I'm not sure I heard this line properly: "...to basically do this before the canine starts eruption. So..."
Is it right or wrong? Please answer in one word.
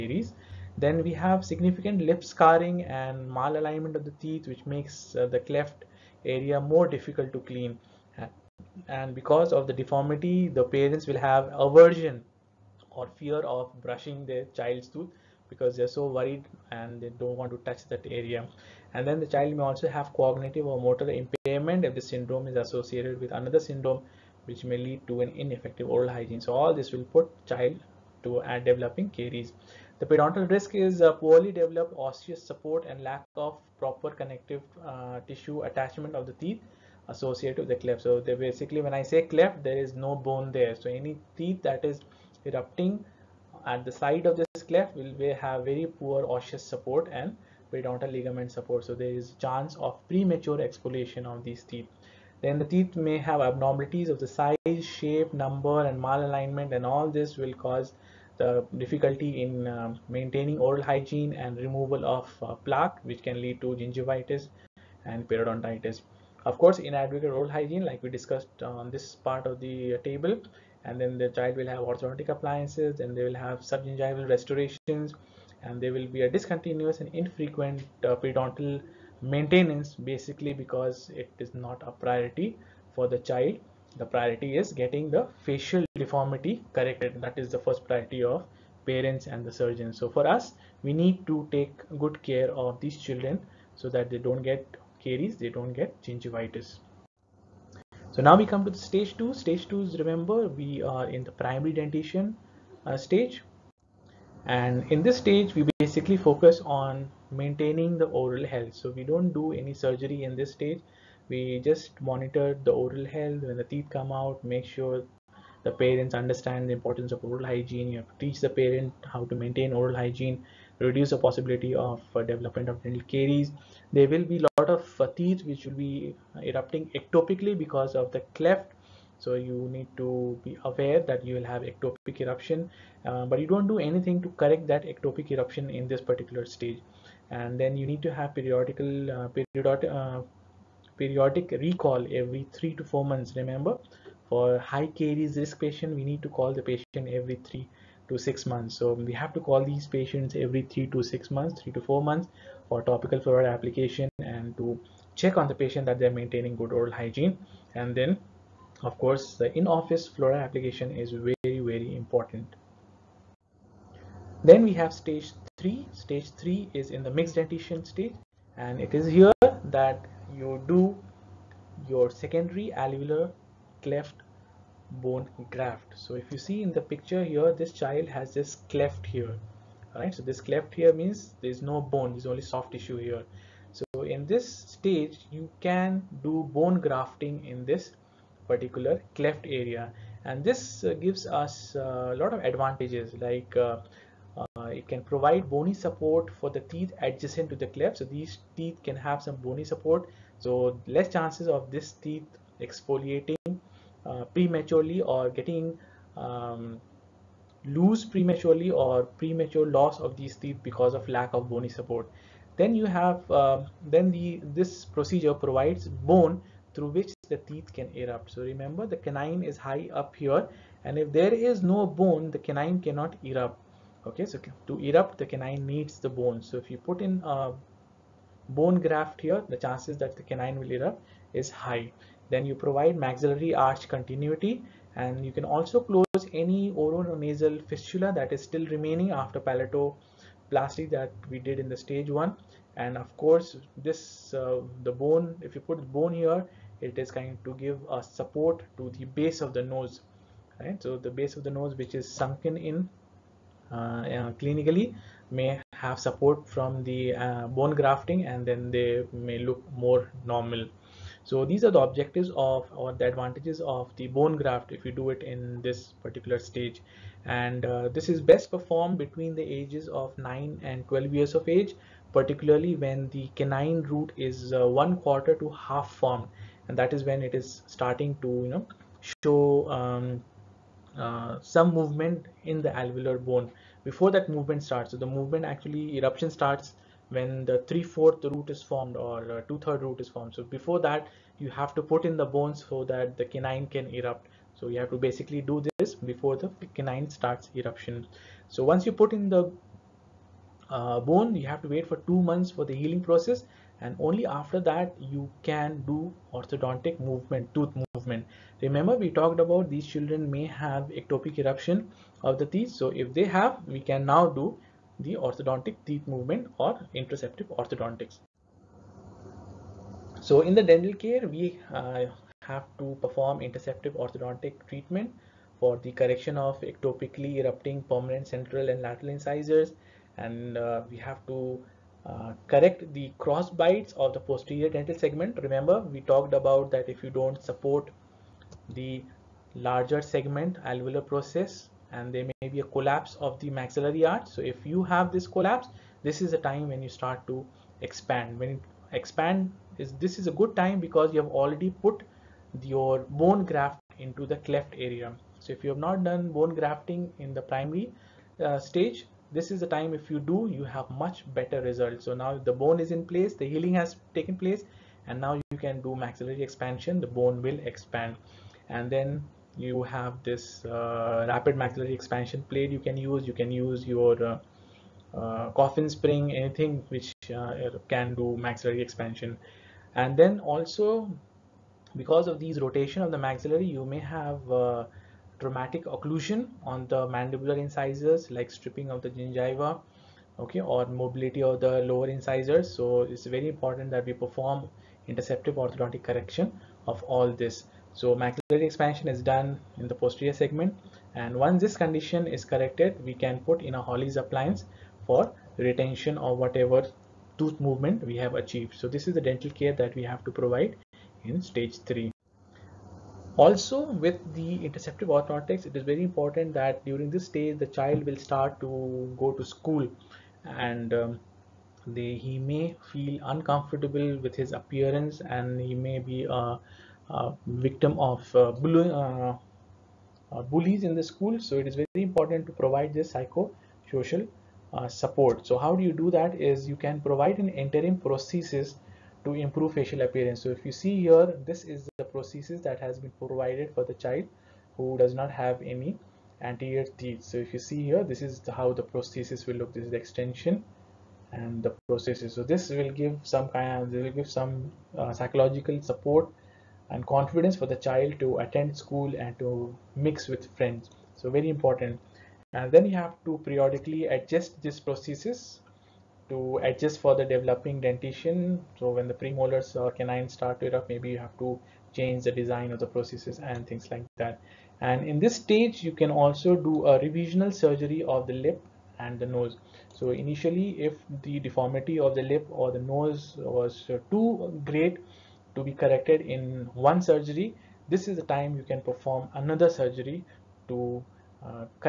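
right.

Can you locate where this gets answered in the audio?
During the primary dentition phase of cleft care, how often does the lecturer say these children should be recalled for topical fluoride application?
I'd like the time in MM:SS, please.
02:31.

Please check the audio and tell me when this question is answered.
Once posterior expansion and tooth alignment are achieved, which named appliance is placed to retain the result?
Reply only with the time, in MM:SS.
06:43.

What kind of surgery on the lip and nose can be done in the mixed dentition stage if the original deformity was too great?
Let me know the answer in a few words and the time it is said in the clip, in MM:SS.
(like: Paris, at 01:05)
revisional surgery, at 07:56.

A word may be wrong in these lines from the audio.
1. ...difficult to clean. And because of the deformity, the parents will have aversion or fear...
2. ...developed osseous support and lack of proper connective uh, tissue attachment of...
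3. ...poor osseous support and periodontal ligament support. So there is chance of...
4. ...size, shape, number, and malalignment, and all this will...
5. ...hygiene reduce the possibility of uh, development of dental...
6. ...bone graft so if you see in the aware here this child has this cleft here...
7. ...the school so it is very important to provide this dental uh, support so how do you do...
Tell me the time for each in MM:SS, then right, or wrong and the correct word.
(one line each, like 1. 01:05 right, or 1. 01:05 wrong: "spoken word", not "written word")
1. 00:06 right
2. 00:31 right
3. 00:45 right
4. 00:54 right
5. 01:59 right
6. 02:55 wrong: "picture", not "aware"
7. 07:10 wrong: "psychosocial", not "dental".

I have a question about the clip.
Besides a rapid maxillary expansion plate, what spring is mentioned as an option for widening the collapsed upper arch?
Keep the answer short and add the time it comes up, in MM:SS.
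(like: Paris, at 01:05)
coffin spring, at 06:15.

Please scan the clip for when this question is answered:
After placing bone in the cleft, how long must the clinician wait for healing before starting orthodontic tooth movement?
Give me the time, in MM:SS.
05:02.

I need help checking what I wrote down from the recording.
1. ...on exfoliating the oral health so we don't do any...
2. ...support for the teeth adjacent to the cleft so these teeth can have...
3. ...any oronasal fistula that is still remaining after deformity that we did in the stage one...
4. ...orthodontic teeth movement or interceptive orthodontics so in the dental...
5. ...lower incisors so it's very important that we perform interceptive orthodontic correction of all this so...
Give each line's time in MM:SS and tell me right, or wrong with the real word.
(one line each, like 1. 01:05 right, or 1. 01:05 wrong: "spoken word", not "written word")
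1. 01:46 wrong: "maintaining", not "exfoliating"
2. 03:15 right
3. 03:56 wrong: "palatoplasty", not "deformity"
4. 05:15 right
5. 06:31 right.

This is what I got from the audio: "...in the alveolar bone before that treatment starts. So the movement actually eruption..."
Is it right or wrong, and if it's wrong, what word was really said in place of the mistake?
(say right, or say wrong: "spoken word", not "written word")
wrong: "movement", not "treatment".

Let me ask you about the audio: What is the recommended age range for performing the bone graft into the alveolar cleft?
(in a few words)
9 to 12 years.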